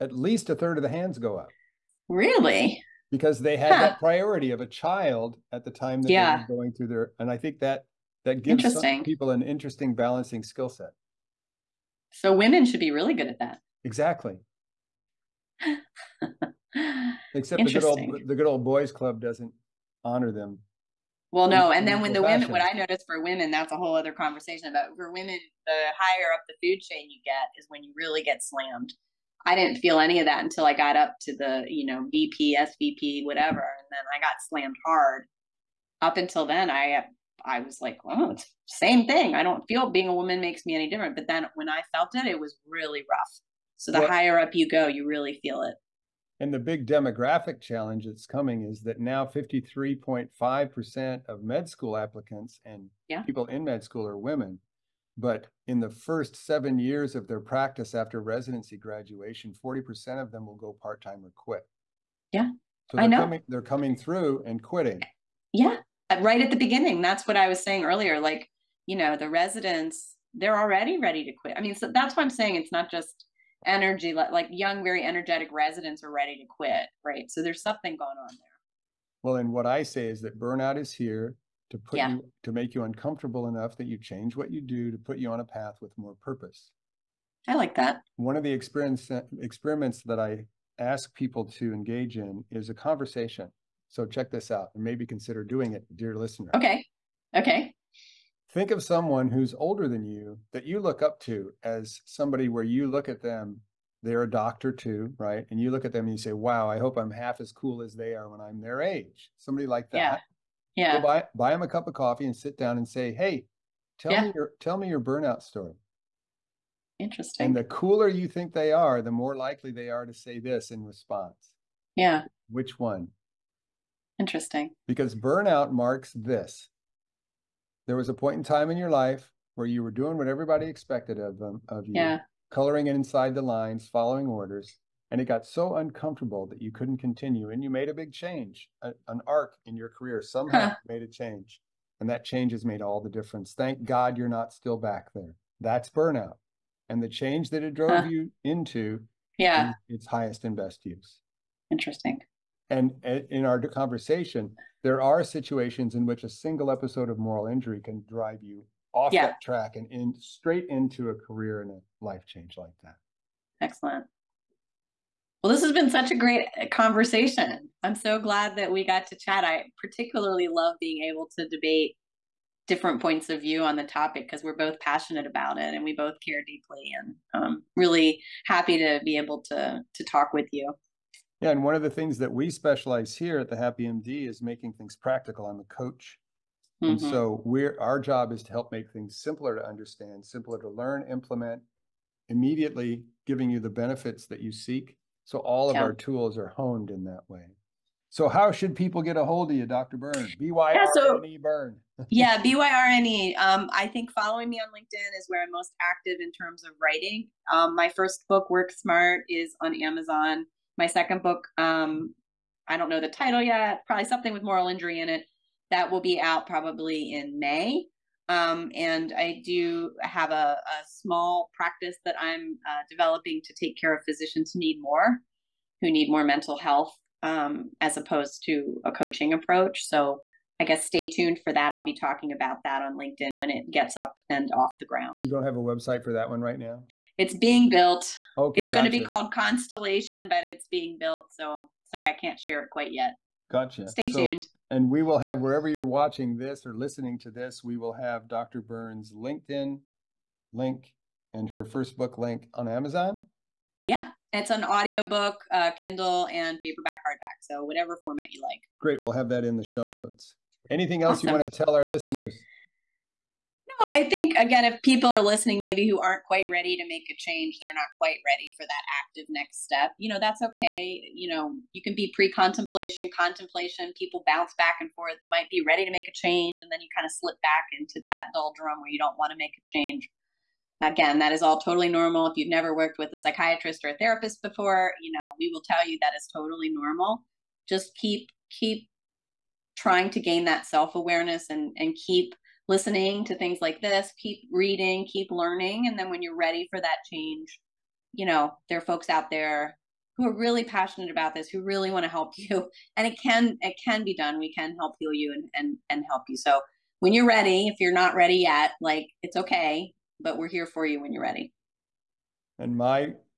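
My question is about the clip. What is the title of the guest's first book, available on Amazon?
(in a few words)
Work Smart.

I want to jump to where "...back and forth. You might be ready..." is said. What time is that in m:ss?
4:34.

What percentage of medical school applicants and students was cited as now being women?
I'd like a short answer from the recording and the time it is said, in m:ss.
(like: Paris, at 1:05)
53.5%, at 0:49.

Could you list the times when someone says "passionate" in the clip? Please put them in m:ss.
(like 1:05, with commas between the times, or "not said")
2:54, 5:00.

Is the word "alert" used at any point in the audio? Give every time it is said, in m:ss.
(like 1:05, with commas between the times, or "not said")
not said.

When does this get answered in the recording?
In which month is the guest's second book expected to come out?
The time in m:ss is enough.
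3:37.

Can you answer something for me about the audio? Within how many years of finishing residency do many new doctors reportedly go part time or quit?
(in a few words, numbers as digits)
7.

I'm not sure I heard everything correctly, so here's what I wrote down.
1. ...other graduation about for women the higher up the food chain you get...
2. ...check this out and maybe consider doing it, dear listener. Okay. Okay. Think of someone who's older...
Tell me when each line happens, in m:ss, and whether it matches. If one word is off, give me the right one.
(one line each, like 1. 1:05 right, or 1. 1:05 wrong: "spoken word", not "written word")
1. 0:23 wrong: "conversation", not "graduation"
2. 1:34 right.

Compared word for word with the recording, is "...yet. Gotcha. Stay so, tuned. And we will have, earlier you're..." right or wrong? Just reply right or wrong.
wrong.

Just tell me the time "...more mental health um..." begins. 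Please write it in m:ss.
3:46.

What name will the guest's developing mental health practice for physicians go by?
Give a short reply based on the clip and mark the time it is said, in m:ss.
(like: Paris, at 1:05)
Constellation, at 3:59.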